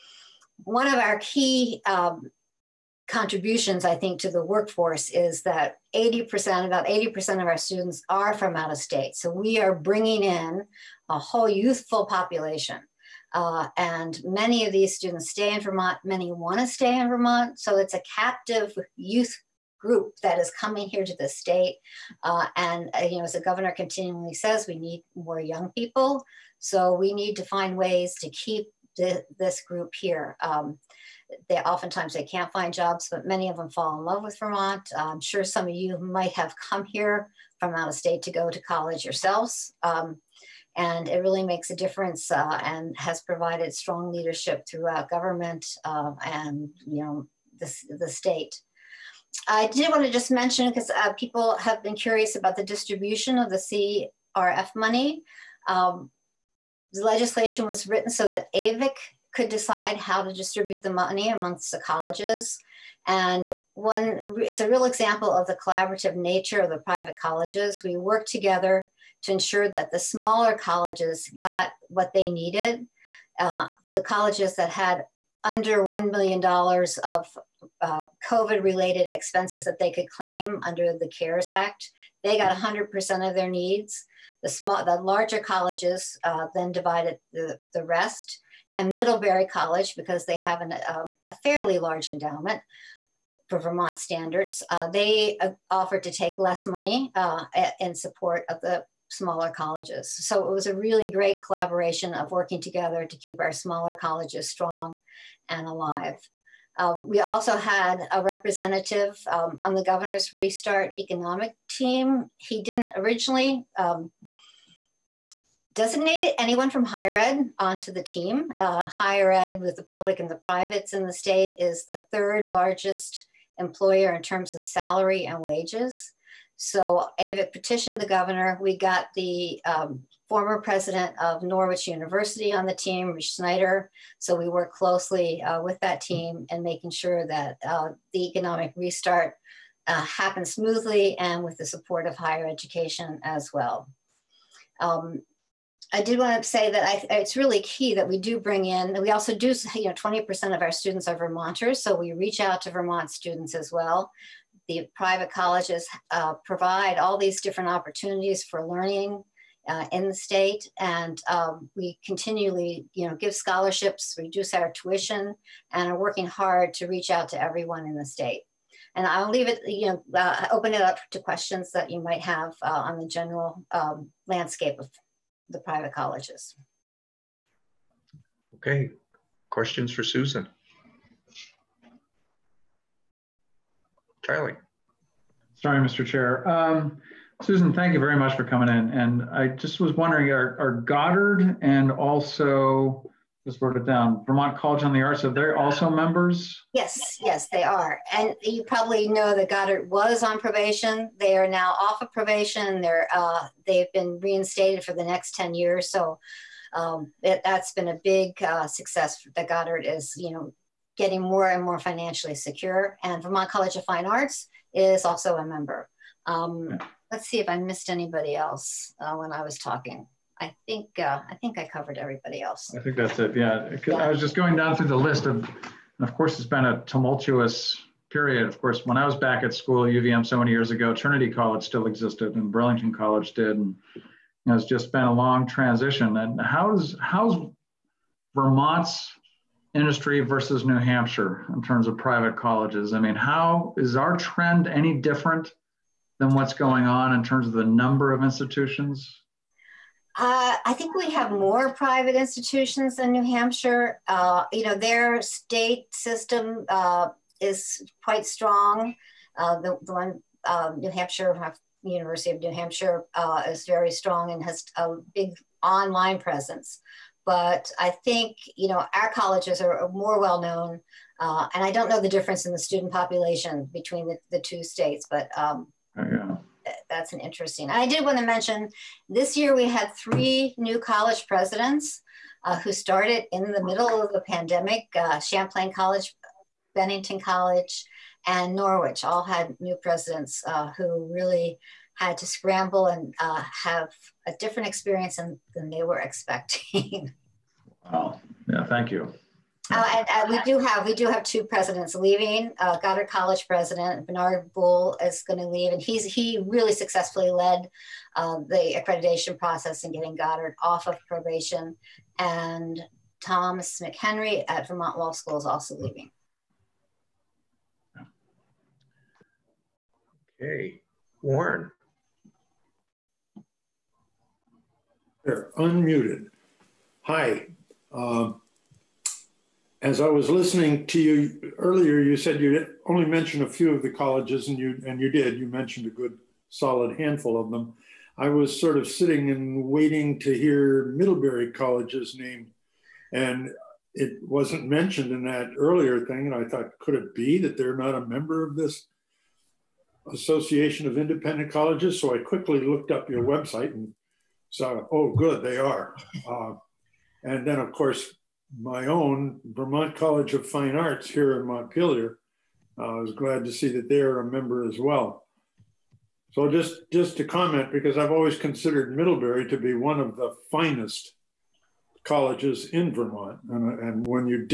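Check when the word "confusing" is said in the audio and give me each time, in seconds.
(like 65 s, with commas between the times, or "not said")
not said.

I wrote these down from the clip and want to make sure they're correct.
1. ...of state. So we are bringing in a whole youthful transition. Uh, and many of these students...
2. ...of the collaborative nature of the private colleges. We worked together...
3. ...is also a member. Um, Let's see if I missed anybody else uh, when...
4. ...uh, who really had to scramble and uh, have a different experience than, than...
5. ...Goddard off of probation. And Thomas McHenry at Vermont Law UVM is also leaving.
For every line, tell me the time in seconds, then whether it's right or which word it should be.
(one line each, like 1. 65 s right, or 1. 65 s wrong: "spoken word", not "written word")
1. 8 s wrong: "population", not "transition"
2. 65 s right
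3. 214 s right
4. 290 s right
5. 310 s wrong: "School", not "UVM".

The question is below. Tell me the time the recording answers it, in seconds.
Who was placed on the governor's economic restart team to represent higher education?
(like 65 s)
133 s.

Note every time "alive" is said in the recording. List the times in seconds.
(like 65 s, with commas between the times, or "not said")
105 s.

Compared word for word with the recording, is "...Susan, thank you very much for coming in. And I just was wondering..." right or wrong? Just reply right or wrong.
right.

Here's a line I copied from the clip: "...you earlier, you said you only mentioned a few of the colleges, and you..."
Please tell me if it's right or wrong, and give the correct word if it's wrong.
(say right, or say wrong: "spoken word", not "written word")
right.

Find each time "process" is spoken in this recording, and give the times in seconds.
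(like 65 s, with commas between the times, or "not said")
309 s.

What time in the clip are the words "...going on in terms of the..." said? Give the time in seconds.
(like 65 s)
246 s.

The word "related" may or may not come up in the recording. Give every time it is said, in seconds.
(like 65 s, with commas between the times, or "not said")
78 s.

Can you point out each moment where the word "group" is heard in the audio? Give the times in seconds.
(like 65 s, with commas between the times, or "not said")
19 s, 29 s.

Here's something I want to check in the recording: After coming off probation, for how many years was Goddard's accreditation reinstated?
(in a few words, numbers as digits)
10 years.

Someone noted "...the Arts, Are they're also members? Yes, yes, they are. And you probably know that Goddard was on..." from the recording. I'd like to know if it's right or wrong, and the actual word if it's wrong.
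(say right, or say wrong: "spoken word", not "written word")
right.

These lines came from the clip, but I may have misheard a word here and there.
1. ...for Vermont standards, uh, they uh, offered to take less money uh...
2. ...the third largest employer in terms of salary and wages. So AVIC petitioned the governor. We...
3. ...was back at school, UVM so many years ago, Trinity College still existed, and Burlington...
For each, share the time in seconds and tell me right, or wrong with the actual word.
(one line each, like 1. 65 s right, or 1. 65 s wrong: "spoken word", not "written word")
1. 93 s right
2. 121 s right
3. 229 s right.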